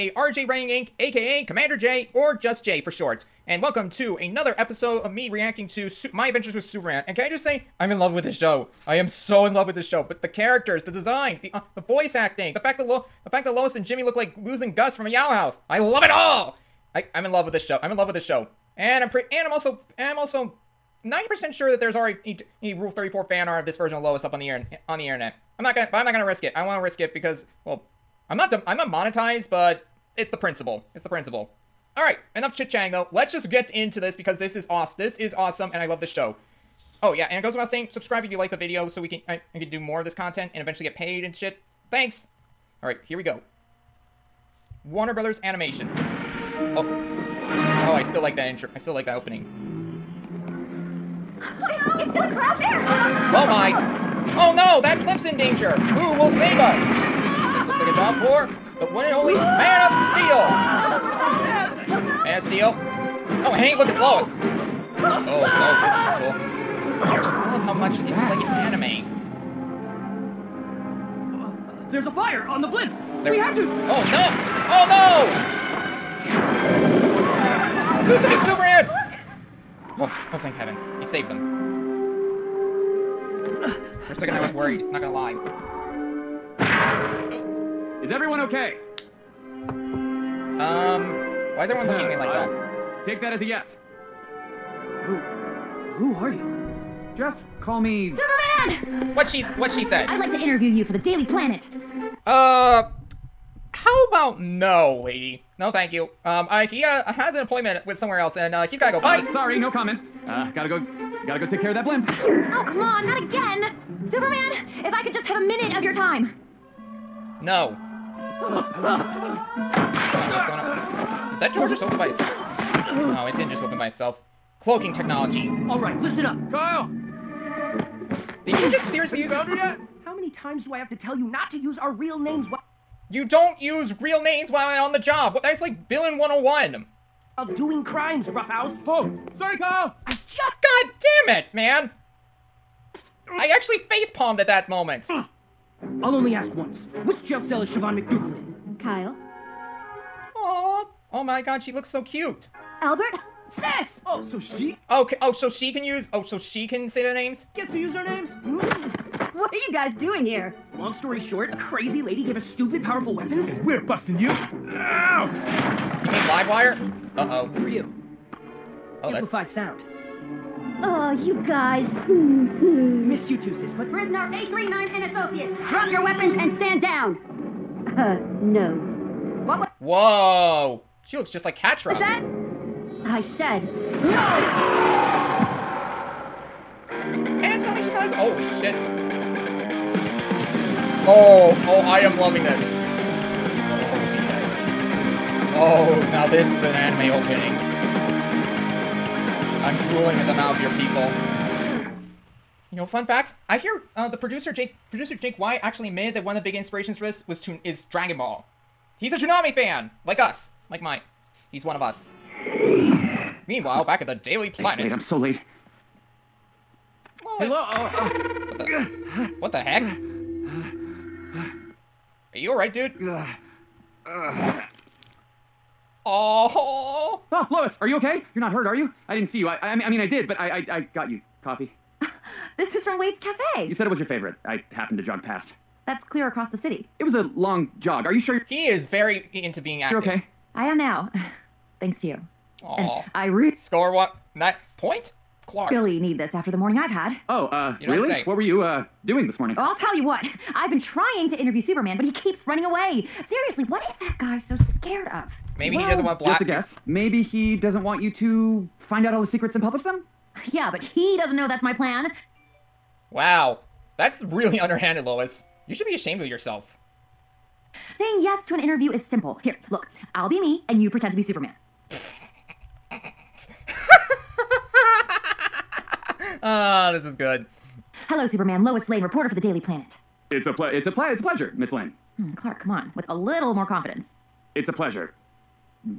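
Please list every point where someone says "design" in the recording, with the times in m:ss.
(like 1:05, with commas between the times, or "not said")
0:10.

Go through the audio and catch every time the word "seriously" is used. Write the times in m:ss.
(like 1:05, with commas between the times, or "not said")
2:08, 4:13.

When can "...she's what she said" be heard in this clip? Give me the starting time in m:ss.
1:39.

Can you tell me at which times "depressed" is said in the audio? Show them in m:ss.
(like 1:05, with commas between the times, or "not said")
not said.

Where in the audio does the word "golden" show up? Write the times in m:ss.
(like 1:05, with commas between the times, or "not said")
not said.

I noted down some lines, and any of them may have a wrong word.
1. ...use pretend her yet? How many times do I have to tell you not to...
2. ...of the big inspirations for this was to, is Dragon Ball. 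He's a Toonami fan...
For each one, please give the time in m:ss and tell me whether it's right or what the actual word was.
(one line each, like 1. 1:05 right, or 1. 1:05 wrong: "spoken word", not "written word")
1. 2:09 wrong: "found", not "pretend"
2. 3:26 right.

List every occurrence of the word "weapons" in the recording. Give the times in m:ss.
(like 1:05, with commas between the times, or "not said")
2:43, 2:56.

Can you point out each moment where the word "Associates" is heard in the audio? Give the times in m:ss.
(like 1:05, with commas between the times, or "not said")
2:55.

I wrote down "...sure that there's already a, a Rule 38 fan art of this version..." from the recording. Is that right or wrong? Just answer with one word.
wrong.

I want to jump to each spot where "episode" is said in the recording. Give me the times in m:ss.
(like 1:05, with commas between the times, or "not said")
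0:04.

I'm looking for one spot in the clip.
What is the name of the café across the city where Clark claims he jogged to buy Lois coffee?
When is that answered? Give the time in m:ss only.
3:52.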